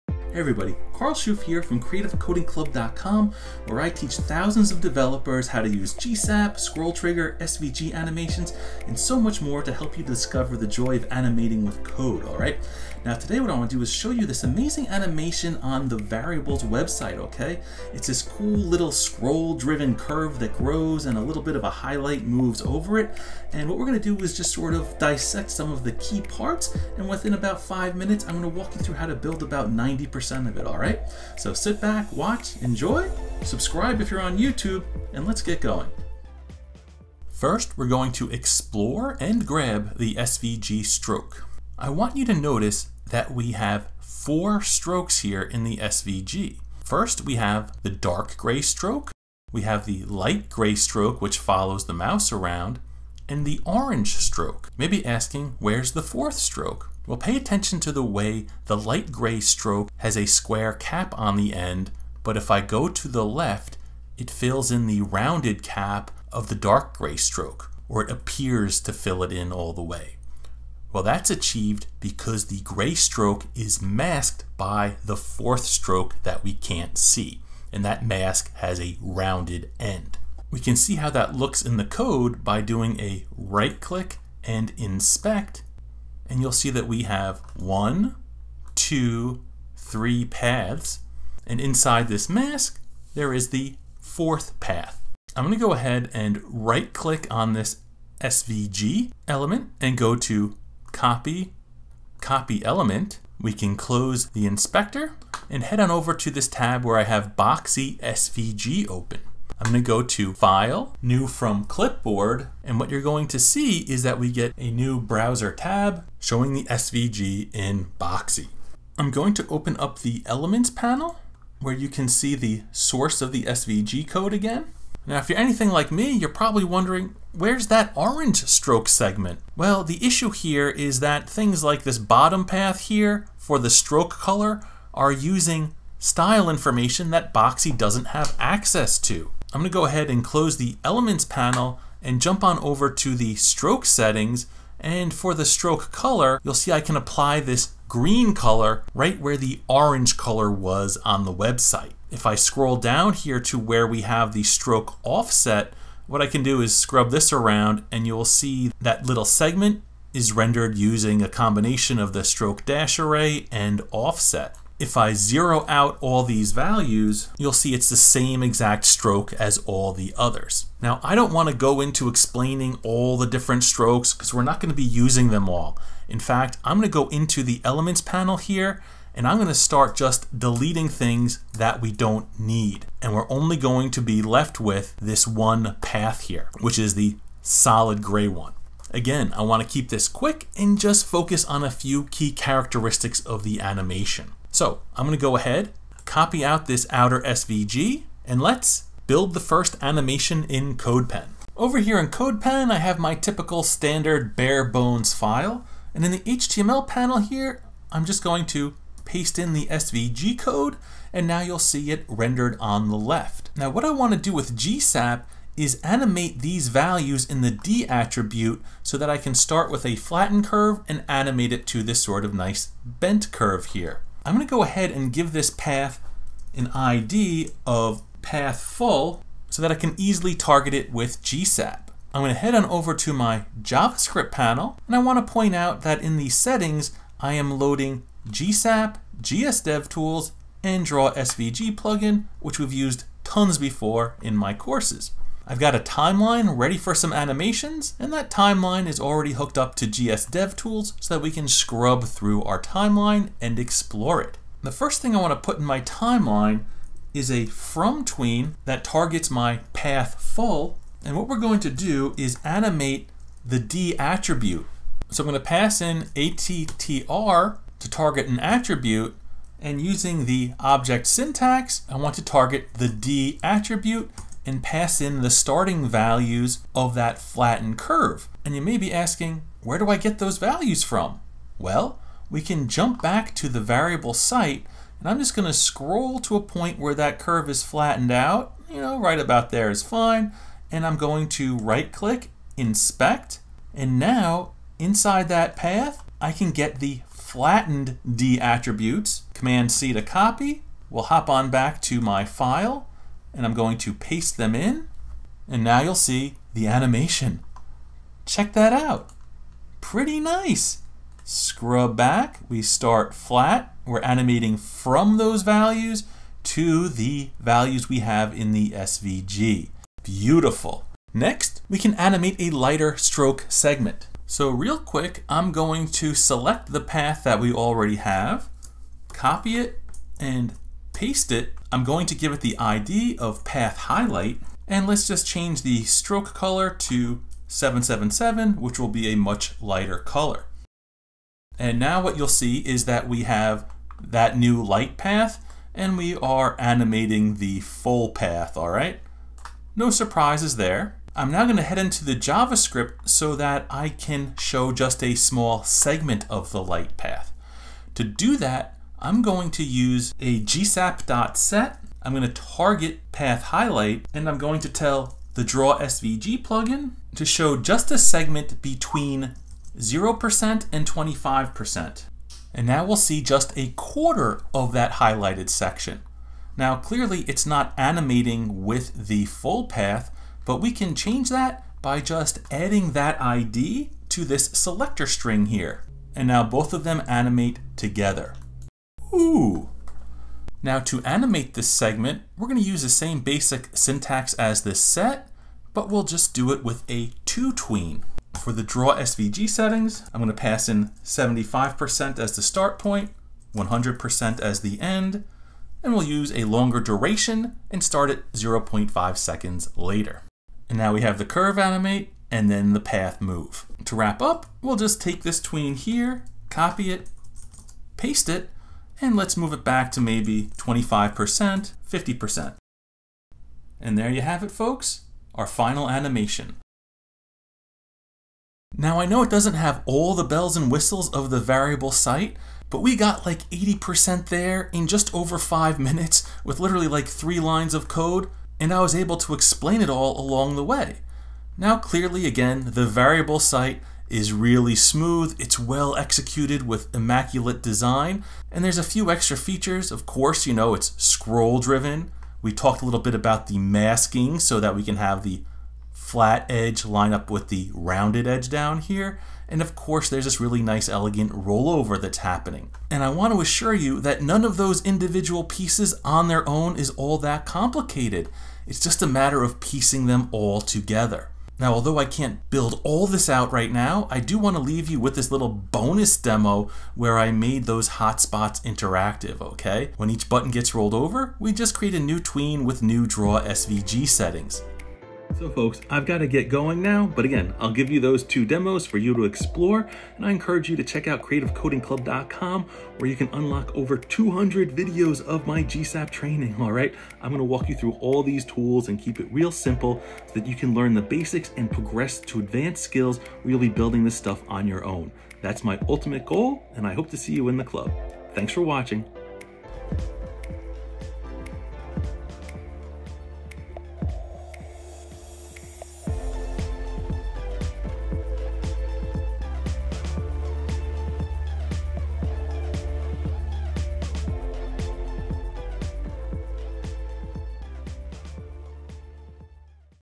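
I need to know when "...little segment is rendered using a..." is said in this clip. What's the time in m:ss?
2:39.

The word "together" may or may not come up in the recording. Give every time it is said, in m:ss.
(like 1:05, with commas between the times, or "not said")
6:27, 7:50.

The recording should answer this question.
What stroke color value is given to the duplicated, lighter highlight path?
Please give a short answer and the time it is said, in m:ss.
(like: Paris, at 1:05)
777, at 5:37.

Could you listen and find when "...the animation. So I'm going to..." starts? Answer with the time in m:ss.
3:13.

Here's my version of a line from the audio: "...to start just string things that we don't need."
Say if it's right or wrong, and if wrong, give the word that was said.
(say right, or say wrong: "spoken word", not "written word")
wrong: "deleting", not "string".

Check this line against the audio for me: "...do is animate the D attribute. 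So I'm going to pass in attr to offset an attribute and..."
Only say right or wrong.
wrong.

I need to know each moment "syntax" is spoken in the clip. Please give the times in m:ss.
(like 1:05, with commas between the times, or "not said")
4:31, 6:33.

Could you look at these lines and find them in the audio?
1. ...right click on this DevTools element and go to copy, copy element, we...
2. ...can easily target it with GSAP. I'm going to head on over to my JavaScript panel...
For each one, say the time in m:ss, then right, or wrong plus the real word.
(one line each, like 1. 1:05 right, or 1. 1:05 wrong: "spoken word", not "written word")
1. 1:36 wrong: "SVG", not "DevTools"
2. 3:49 right.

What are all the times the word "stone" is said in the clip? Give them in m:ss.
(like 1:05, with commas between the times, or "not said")
not said.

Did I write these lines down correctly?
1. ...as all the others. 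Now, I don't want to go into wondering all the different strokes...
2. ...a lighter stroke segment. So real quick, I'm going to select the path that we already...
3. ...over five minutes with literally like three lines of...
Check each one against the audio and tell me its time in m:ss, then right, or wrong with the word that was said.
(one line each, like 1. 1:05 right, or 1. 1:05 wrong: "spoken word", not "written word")
1. 2:49 wrong: "explaining", not "wondering"
2. 5:22 right
3. 7:15 right.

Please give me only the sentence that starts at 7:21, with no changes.
Now clearly again, the variable site is really smooth, it's well executed with immaculate design, and there's a few extra features.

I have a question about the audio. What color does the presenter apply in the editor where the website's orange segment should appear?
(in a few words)
Green.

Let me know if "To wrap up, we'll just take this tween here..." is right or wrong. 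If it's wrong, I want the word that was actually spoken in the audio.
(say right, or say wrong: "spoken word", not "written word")
right.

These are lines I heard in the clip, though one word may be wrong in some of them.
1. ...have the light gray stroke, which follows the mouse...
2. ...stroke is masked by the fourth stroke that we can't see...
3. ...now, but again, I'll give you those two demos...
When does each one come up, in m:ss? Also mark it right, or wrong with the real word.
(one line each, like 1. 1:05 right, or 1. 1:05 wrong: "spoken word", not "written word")
1. 0:49 right
2. 1:12 right
3. 8:06 right.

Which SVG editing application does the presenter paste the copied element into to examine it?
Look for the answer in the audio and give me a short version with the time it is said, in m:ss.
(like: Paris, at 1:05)
Boxy SVG, at 1:47.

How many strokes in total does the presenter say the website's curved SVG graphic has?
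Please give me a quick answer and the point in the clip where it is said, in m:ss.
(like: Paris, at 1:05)
4, at 0:43.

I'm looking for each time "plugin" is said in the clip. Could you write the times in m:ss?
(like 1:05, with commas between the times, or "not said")
4:01, 6:06.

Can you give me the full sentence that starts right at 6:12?
And now we'll see just a quarter of that highlighted section.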